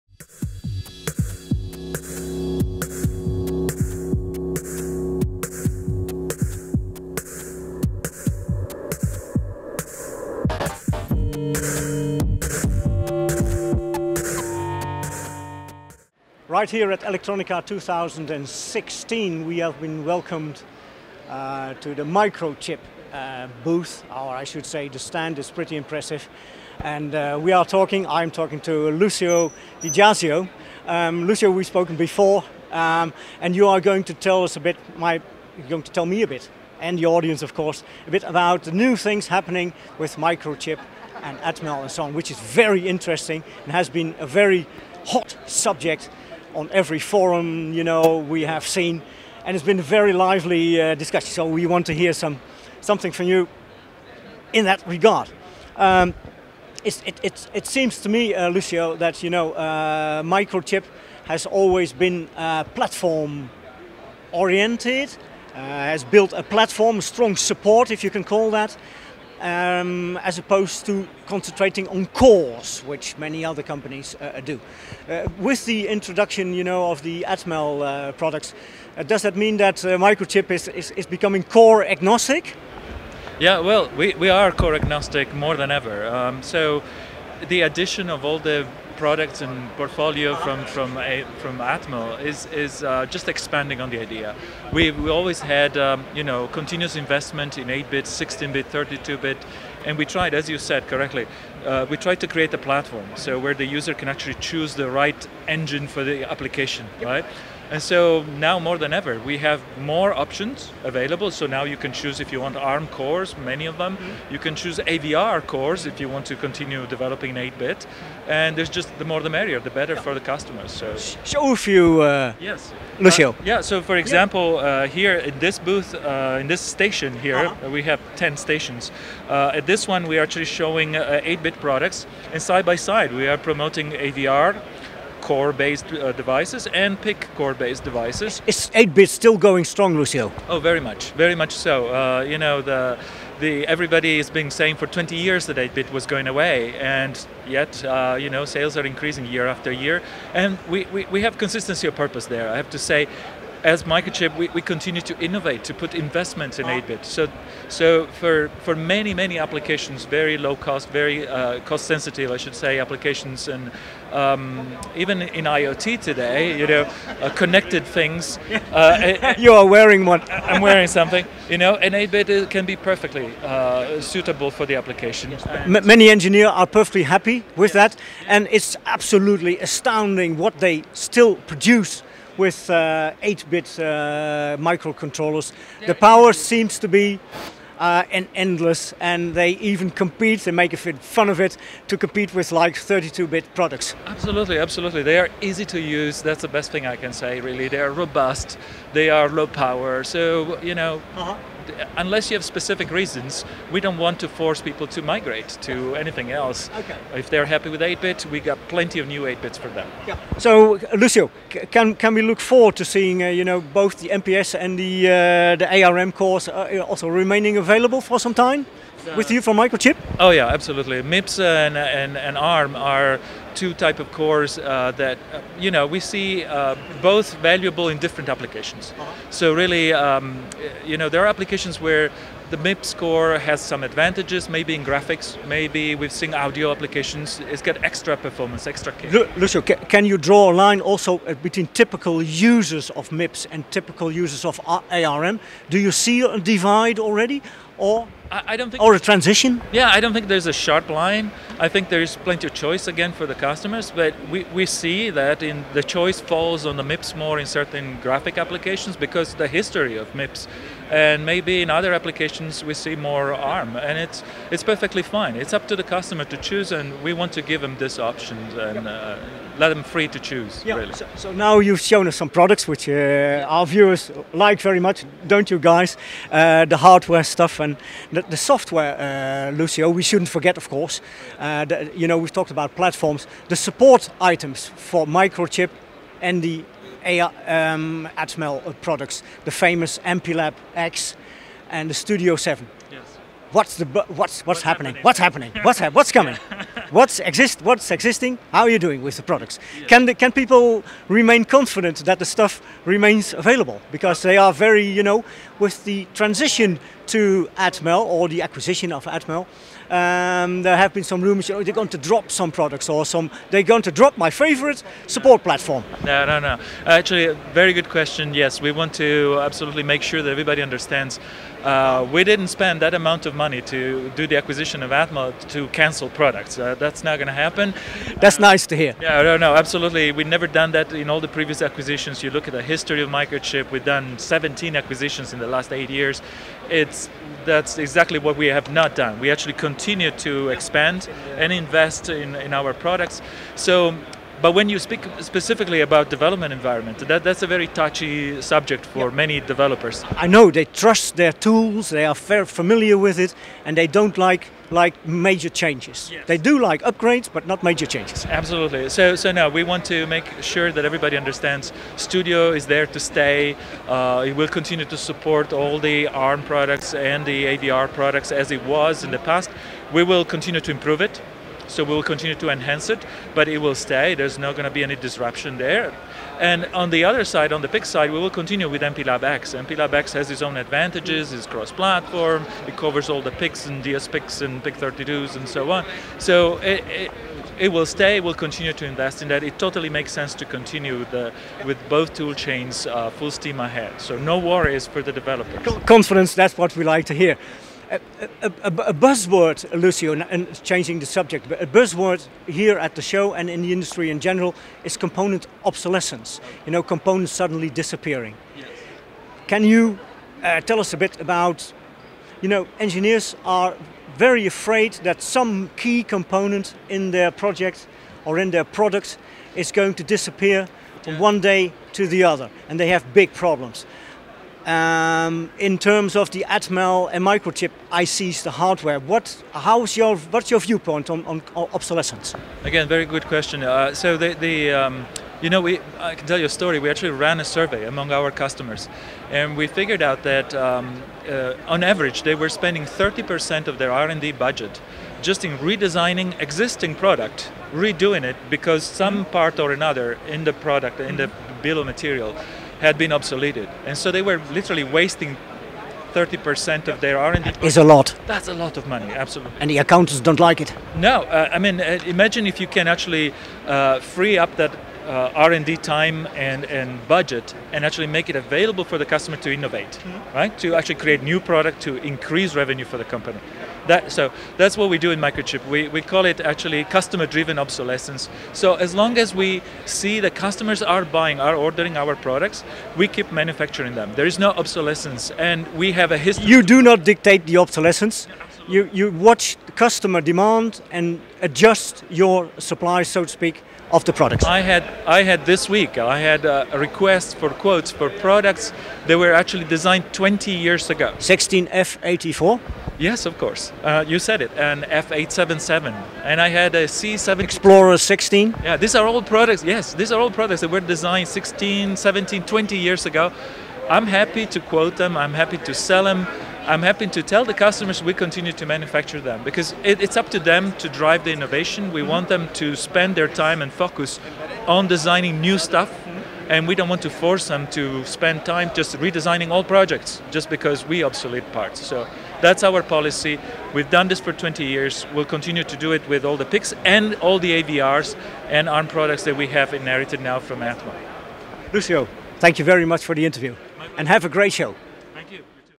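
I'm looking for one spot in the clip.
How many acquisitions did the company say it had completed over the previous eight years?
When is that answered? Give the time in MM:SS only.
05:34.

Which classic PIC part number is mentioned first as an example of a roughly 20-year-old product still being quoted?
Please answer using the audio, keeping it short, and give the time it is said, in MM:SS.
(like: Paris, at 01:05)
16F84, at 08:21.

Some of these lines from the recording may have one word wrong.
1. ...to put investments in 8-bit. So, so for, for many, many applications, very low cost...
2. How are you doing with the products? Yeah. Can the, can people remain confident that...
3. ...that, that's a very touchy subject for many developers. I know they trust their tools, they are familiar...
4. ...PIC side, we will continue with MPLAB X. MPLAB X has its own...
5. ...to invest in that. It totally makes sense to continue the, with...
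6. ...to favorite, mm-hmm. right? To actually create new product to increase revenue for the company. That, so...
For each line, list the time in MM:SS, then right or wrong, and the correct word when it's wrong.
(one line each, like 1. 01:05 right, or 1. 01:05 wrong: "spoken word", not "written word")
1. 02:35 right
2. 04:58 right
3. 05:47 right
4. 06:17 right
5. 06:28 right
6. 07:49 wrong: "innovate", not "favorite".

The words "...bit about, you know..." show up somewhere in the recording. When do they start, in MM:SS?
06:50.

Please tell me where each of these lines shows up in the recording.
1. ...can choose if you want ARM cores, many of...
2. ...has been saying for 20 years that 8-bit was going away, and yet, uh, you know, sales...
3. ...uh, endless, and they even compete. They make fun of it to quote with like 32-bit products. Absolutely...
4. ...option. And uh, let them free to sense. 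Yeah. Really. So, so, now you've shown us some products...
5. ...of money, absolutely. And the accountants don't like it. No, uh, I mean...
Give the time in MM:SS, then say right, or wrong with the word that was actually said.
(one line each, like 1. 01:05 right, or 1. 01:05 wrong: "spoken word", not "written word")
1. 01:51 right
2. 02:24 right
3. 03:07 wrong: "compete", not "quote"
4. 04:27 wrong: "choose", not "sense"
5. 07:38 right.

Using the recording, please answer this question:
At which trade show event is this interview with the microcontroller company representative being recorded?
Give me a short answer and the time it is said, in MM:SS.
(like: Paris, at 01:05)
Electronica 2016, at 00:17.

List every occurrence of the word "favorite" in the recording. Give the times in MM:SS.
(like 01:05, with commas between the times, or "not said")
05:14.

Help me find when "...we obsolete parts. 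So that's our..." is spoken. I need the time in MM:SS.
08:50.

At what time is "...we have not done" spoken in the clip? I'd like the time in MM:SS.
05:38.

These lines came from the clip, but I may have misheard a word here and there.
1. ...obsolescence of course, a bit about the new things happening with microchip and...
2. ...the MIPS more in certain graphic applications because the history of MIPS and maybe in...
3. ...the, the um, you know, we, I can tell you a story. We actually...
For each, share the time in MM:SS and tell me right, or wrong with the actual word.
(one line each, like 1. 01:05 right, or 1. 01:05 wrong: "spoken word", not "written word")
1. 00:37 wrong: "audience", not "obsolescence"
2. 04:16 right
3. 07:14 right.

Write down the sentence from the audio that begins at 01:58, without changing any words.
And there's just the more the merrier, the better yeah.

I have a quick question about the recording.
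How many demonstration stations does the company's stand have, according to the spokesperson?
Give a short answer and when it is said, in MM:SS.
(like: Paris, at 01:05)
10, at 02:08.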